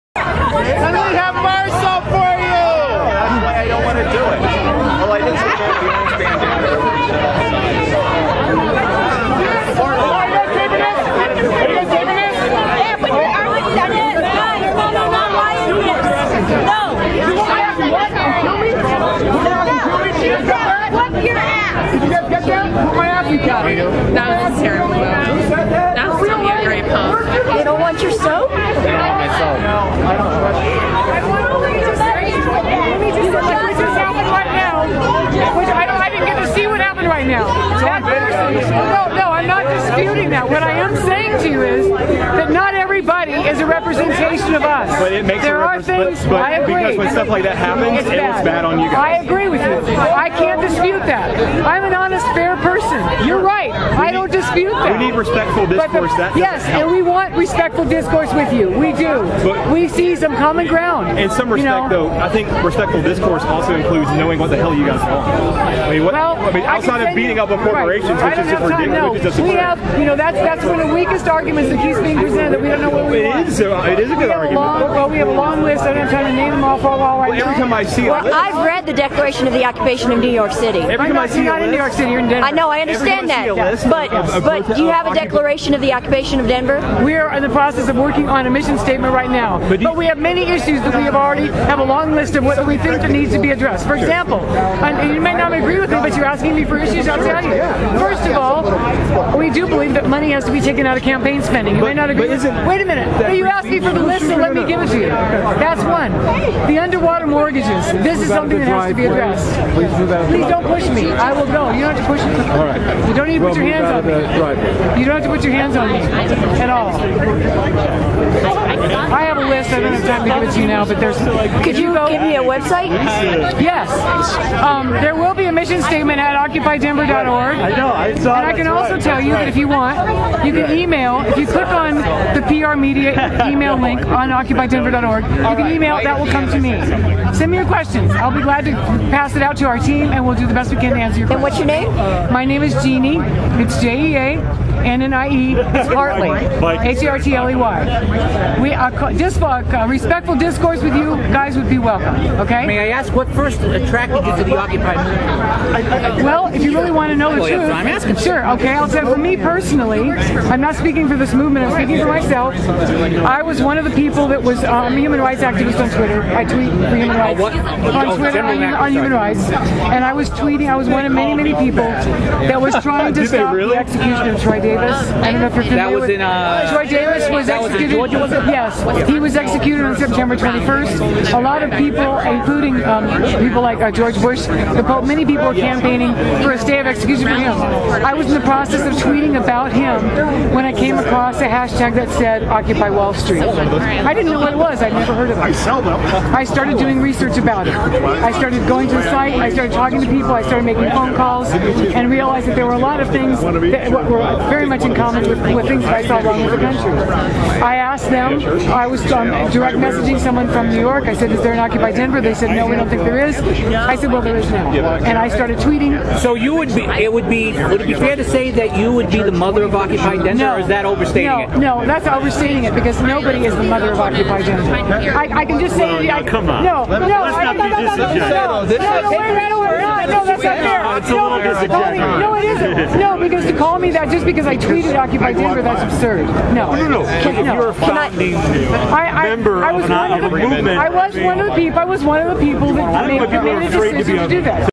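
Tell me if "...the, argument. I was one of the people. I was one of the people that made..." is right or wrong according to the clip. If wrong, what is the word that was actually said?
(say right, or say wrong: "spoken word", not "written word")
wrong: "movement", not "argument".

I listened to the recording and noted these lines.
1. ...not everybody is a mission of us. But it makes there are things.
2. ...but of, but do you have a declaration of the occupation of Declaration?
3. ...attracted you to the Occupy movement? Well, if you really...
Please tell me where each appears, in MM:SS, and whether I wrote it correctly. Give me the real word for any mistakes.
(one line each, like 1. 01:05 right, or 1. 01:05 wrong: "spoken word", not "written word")
1. 00:42 wrong: "representation", not "mission"
2. 01:23 wrong: "Denver", not "Declaration"
3. 02:33 right.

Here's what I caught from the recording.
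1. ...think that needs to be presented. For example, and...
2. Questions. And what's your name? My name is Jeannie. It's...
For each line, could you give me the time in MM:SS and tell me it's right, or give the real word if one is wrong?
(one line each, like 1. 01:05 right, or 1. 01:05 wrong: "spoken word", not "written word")
1. 01:32 wrong: "addressed", not "presented"
2. 02:21 right.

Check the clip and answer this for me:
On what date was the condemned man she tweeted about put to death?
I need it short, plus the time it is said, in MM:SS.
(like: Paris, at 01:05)
September 21, at 02:59.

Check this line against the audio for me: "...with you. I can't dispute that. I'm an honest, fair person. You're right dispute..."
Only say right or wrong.
right.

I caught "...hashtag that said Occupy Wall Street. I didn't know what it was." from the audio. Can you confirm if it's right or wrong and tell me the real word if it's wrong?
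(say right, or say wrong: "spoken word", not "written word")
right.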